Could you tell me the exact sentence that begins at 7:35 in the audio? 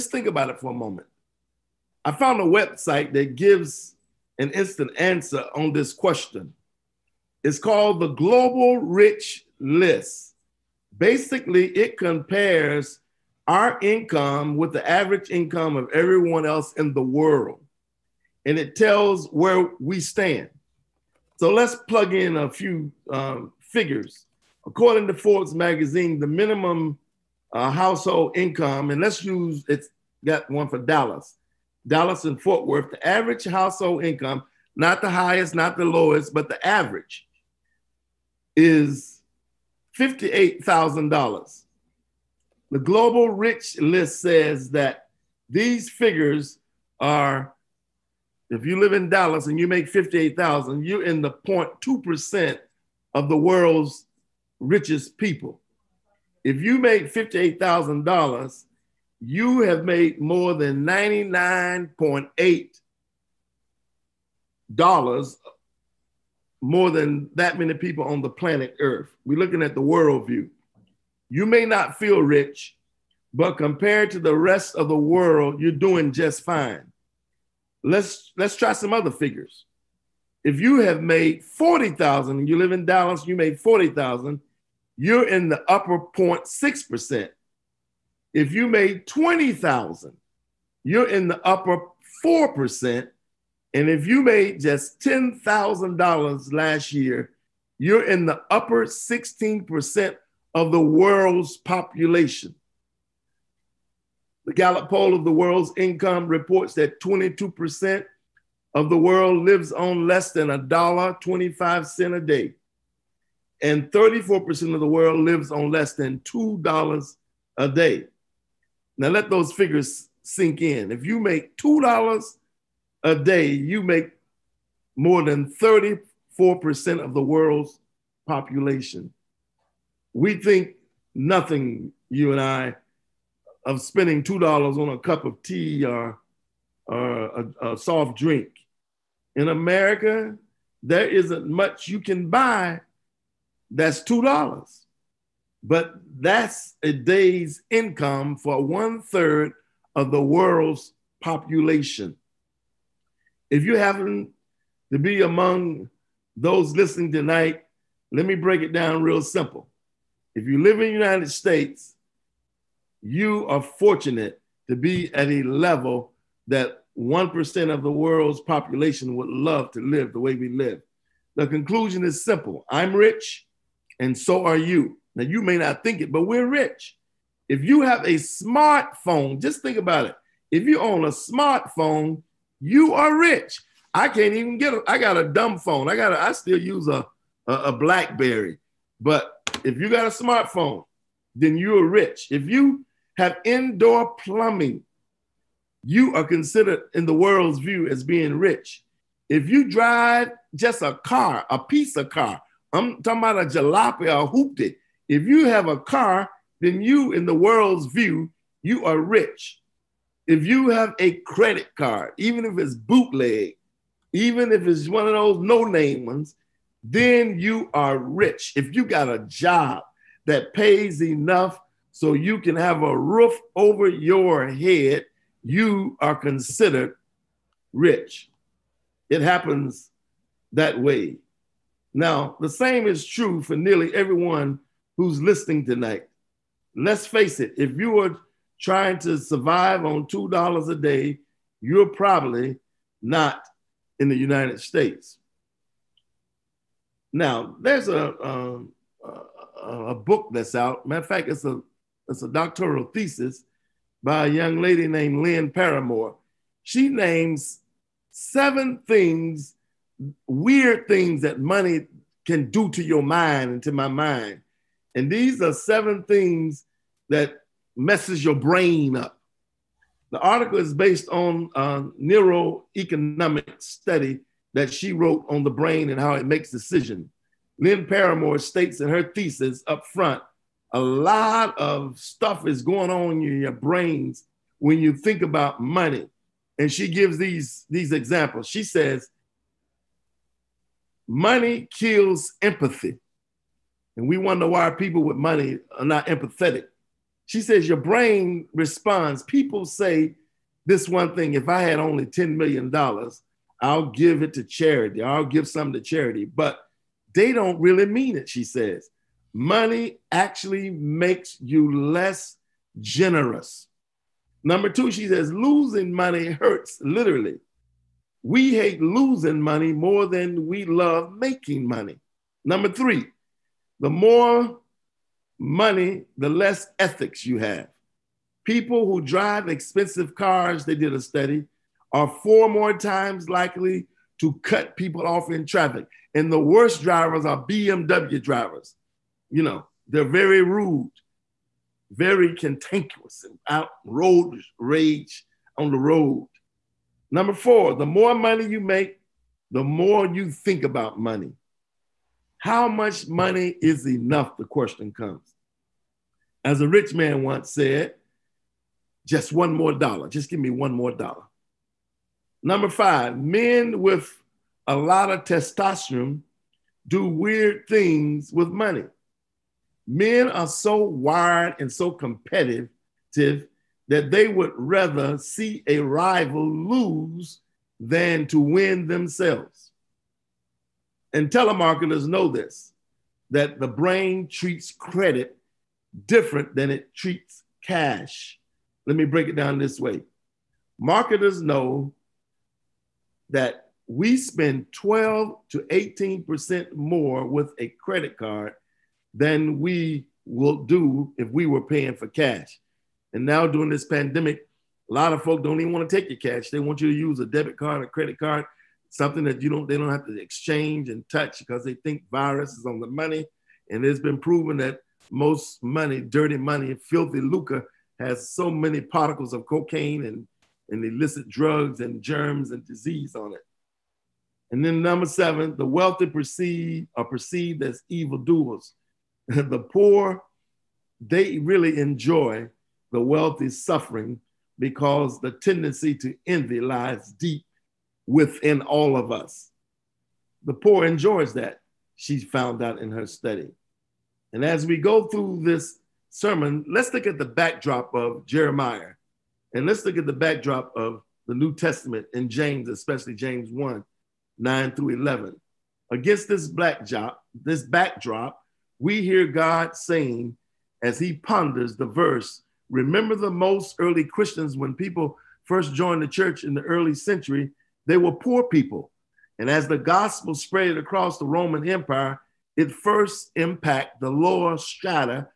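Against this backdrop, this backdrop, we hear God saying as he ponders the verse.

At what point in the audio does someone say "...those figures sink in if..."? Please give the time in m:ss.
1:59.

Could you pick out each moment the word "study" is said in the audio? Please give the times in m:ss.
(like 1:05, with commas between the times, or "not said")
4:33, 5:30, 7:23.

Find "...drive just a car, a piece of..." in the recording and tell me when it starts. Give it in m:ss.
3:19.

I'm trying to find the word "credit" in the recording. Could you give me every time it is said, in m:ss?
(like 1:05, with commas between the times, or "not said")
3:31, 6:24, 6:37, 6:47.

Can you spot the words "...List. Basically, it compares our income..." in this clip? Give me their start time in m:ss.
0:09.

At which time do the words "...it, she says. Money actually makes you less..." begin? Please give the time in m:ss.
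5:08.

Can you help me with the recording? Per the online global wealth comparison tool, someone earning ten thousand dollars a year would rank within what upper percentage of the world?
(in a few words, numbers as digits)
16%.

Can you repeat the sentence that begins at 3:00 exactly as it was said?
If you own a smartphone, you are rich.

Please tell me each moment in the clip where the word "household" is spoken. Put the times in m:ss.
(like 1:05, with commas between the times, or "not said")
0:27, 0:33.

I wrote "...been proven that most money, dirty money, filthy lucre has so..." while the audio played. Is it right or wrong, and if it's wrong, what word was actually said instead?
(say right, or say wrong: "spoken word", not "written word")
right.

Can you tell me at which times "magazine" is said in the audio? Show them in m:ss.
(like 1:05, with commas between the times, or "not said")
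0:25.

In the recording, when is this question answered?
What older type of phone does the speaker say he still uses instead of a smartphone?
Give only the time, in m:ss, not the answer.
3:07.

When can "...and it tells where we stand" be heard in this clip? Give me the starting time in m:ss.
0:18.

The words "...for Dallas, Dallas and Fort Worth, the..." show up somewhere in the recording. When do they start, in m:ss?
0:30.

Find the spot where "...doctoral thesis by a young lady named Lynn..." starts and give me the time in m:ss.
4:12.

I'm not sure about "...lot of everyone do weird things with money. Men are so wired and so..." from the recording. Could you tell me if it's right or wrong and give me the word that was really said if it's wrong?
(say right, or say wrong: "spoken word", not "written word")
wrong: "testosterone", not "everyone".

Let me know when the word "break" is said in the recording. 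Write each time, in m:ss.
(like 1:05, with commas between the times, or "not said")
2:38, 6:29.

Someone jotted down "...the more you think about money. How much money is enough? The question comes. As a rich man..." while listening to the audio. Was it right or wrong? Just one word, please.
right.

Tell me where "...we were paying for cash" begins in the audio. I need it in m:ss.
6:41.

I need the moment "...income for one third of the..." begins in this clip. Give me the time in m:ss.
2:27.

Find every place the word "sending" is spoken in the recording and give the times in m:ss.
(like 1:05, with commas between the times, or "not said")
not said.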